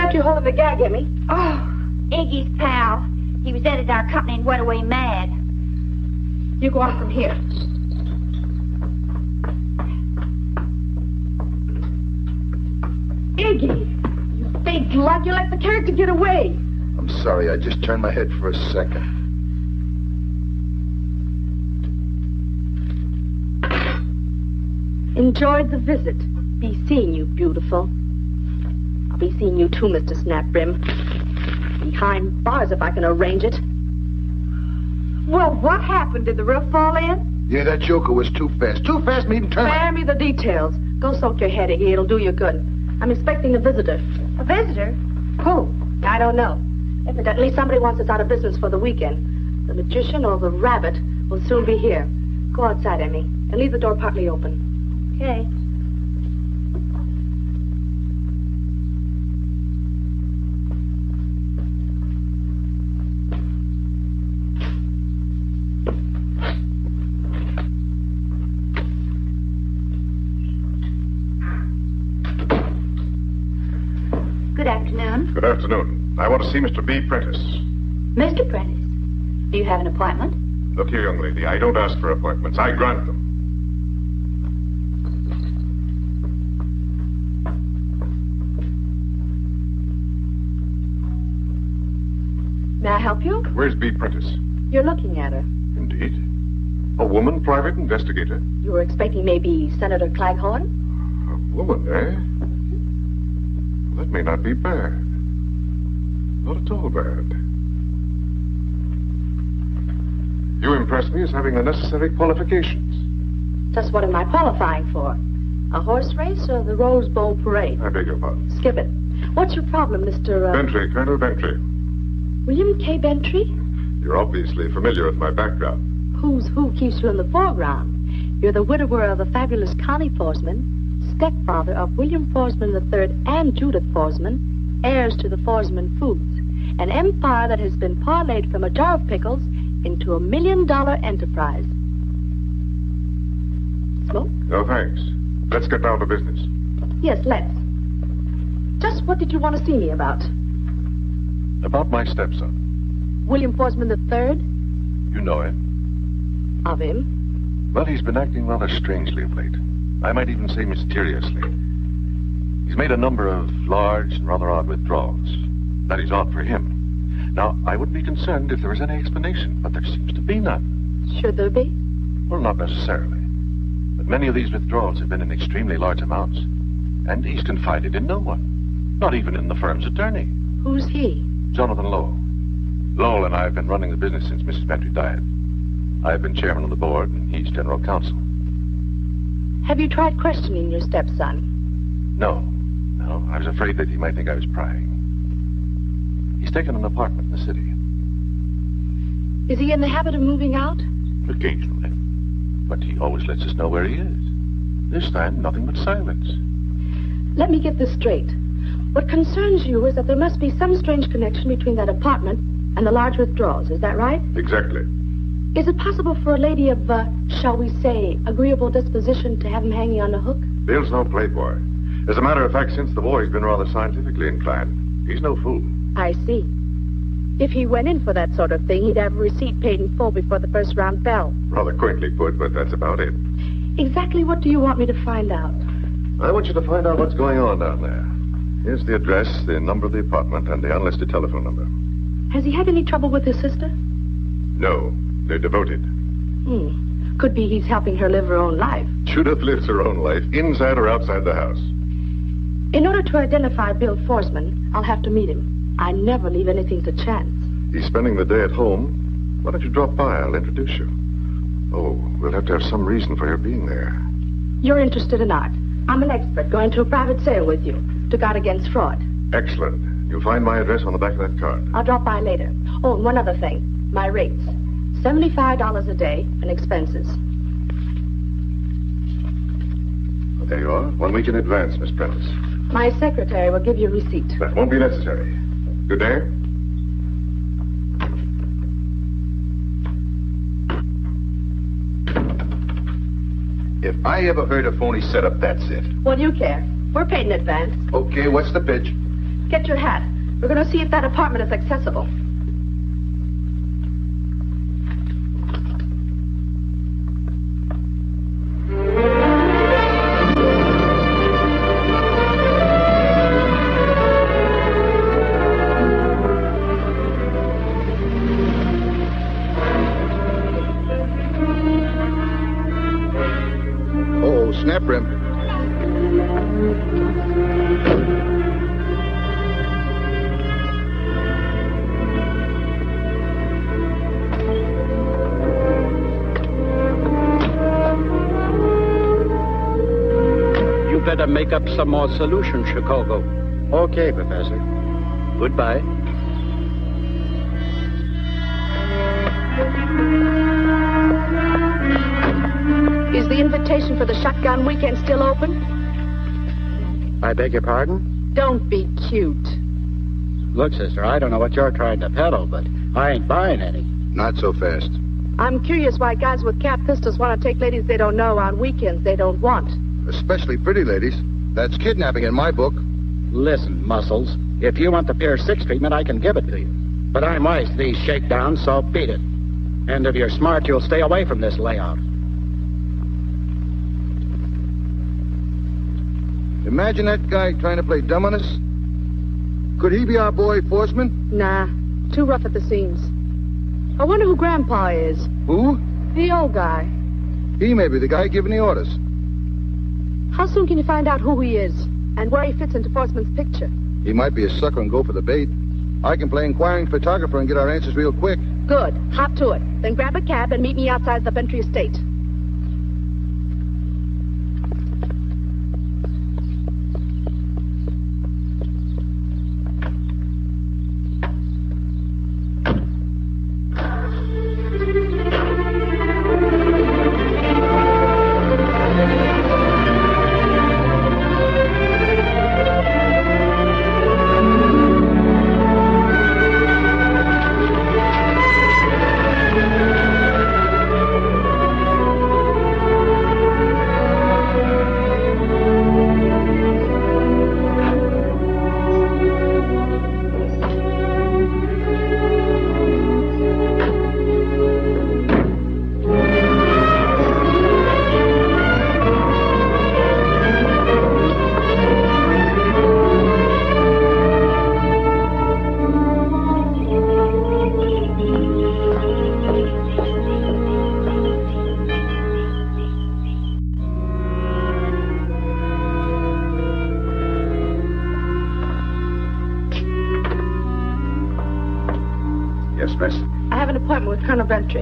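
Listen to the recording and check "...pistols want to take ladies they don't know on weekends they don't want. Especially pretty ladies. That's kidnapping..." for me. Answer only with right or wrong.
right.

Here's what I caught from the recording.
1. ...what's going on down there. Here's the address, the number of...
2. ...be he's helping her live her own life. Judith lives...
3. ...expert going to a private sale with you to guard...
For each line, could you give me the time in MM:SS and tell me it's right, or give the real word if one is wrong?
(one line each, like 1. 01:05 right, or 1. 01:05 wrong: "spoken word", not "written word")
1. 03:56 right
2. 04:07 right
3. 04:26 right.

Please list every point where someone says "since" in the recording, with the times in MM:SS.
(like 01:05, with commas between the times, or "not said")
03:04, 03:42.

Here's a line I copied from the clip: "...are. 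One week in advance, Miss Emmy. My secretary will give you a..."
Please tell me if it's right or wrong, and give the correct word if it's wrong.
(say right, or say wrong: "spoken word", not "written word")
wrong: "Prentice", not "Emmy".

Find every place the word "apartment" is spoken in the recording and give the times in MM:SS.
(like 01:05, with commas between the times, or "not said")
03:16, 03:31, 03:59, 05:01.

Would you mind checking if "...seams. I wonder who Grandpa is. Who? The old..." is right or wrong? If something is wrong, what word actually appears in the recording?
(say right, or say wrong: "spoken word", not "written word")
right.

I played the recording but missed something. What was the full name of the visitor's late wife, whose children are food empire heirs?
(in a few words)
Connie Foresman.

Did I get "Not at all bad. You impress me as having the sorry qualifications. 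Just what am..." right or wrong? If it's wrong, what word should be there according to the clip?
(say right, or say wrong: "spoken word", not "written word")
wrong: "necessary", not "sorry".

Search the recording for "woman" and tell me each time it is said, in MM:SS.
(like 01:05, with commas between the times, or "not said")
01:37, 01:41.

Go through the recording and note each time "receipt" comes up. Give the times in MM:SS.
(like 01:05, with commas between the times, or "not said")
03:49, 04:43.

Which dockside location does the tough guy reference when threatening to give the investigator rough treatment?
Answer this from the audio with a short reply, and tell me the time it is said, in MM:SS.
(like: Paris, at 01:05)
Pier 6, at 06:15.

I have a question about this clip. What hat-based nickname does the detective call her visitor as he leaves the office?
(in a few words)
Mr. Snapbrim.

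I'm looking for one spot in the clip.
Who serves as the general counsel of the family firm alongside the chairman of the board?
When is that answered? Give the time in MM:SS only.
03:01.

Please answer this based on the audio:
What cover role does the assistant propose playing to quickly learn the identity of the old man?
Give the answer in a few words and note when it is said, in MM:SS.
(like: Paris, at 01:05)
inquiring photographer, at 06:46.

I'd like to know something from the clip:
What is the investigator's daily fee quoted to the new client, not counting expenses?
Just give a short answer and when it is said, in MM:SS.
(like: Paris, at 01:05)
$75, at 04:35.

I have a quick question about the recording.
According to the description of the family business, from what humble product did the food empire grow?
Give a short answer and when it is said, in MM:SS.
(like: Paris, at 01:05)
a jar of pickles, at 02:18.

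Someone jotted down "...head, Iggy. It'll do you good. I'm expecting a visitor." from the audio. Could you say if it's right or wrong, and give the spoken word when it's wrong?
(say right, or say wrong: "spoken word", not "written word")
right.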